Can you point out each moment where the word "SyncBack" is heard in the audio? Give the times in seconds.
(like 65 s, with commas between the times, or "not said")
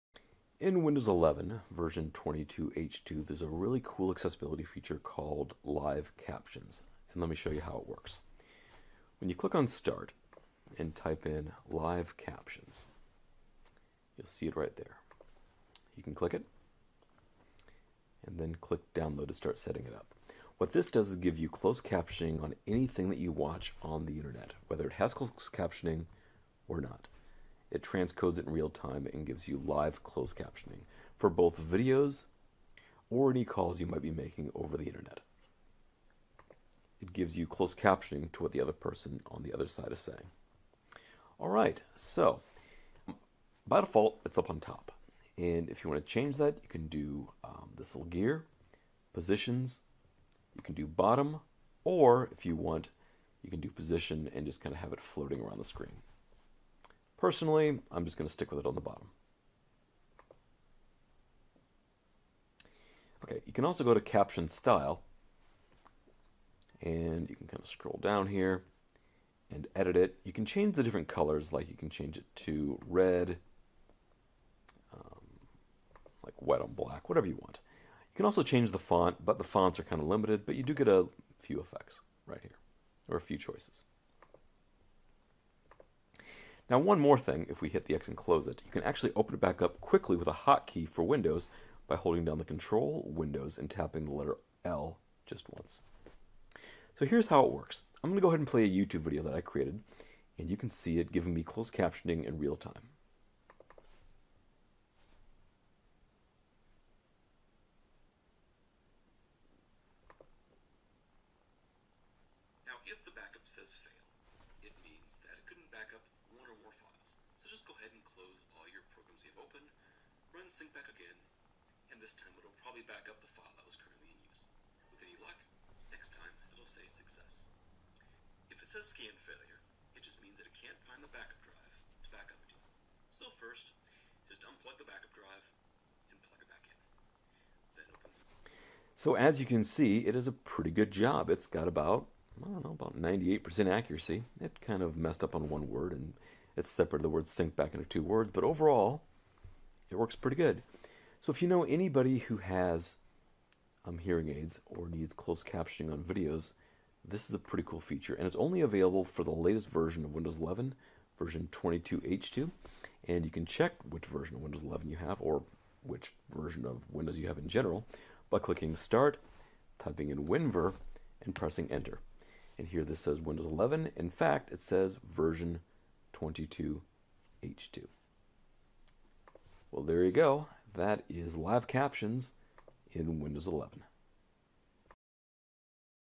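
120 s, 147 s.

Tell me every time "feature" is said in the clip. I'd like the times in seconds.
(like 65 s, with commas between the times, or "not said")
4 s, 157 s.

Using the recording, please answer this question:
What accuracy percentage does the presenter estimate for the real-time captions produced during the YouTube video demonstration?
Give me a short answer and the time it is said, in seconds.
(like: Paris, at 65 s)
98%, at 142 s.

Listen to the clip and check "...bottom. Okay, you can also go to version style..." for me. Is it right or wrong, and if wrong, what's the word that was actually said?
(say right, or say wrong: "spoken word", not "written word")
wrong: "caption", not "version".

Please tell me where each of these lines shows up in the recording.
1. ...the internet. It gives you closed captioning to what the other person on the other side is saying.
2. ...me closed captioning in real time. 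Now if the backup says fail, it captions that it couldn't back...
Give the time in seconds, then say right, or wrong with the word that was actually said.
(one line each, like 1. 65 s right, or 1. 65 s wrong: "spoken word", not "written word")
1. 34 s right
2. 101 s wrong: "means", not "captions".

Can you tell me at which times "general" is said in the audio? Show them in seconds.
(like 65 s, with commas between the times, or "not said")
167 s.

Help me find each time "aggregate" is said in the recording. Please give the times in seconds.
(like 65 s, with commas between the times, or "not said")
not said.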